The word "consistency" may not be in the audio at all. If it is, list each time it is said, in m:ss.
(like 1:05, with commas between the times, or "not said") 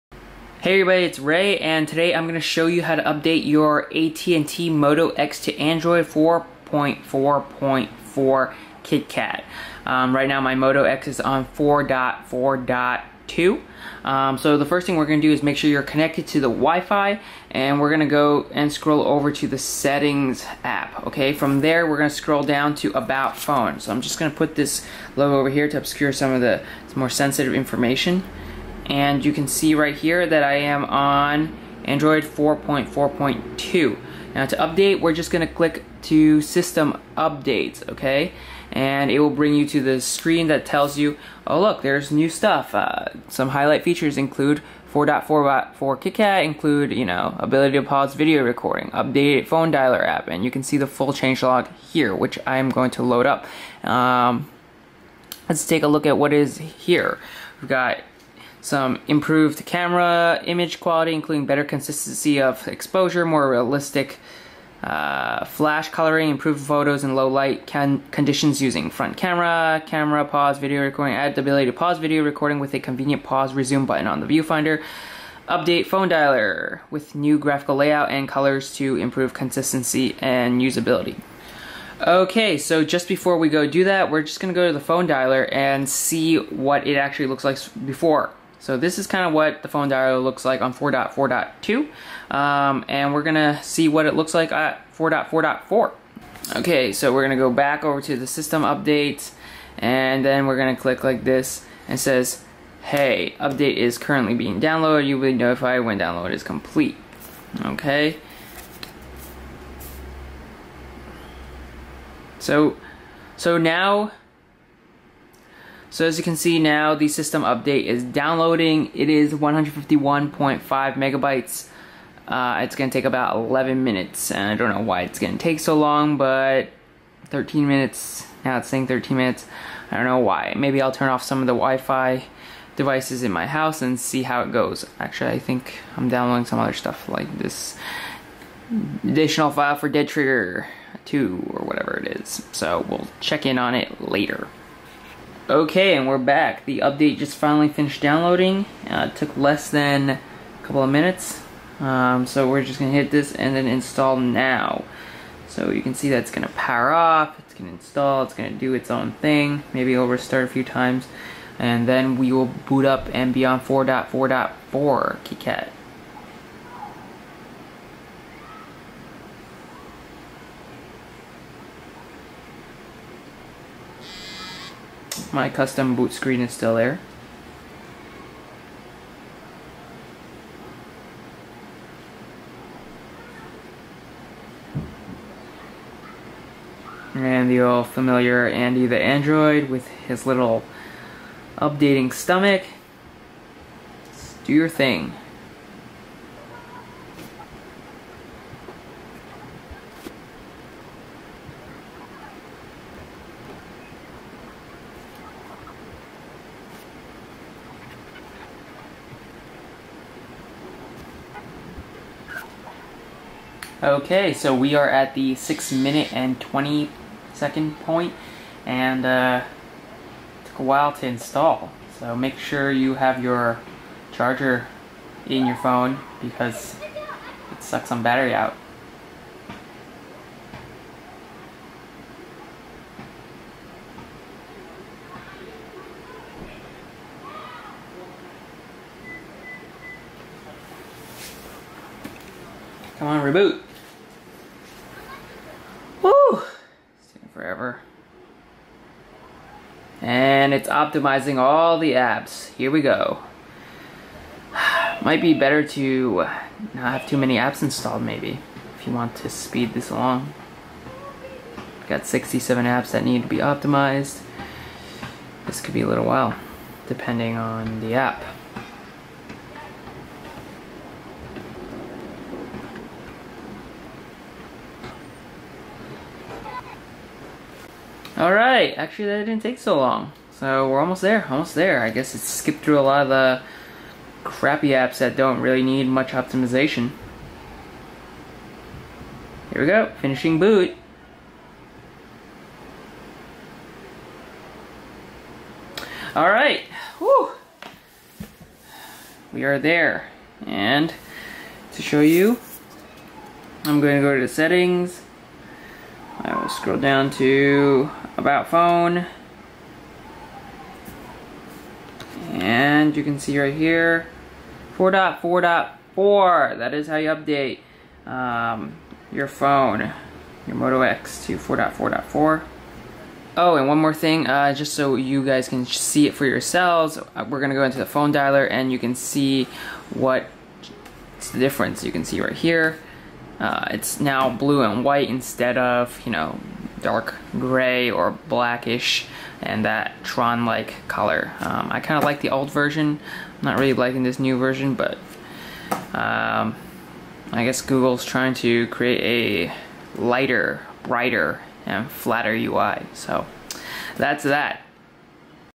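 1:01, 1:19.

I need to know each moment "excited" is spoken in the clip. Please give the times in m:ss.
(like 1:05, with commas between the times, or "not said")
not said.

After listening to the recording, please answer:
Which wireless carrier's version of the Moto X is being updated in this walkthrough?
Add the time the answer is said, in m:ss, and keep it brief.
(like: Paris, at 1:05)
AT&T, at 0:03.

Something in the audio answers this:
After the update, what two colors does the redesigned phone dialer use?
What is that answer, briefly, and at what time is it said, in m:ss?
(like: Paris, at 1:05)
blue and white, at 5:34.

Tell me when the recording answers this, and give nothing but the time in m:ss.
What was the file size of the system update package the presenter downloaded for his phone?
1:59.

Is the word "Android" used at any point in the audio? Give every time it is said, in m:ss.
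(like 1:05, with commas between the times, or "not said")
0:05, 0:31, 3:09.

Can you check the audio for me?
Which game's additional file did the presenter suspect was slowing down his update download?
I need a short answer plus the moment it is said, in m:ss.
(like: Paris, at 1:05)
Dead Trigger 2, at 2:19.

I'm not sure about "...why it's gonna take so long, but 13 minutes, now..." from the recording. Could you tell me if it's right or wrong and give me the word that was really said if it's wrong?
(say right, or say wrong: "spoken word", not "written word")
right.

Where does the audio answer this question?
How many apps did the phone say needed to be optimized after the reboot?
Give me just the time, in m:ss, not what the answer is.
4:22.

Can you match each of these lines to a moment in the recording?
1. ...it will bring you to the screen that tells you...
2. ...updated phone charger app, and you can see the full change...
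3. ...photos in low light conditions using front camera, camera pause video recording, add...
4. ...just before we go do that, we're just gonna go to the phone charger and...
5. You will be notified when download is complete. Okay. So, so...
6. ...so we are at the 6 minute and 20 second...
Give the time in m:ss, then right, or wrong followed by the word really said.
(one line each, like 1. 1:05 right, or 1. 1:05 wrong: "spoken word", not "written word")
1. 0:39 right
2. 0:48 wrong: "dialer", not "charger"
3. 1:06 right
4. 1:22 wrong: "dialer", not "charger"
5. 1:45 right
6. 3:34 right.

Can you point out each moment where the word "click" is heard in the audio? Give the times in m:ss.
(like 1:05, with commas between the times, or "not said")
0:35, 1:40.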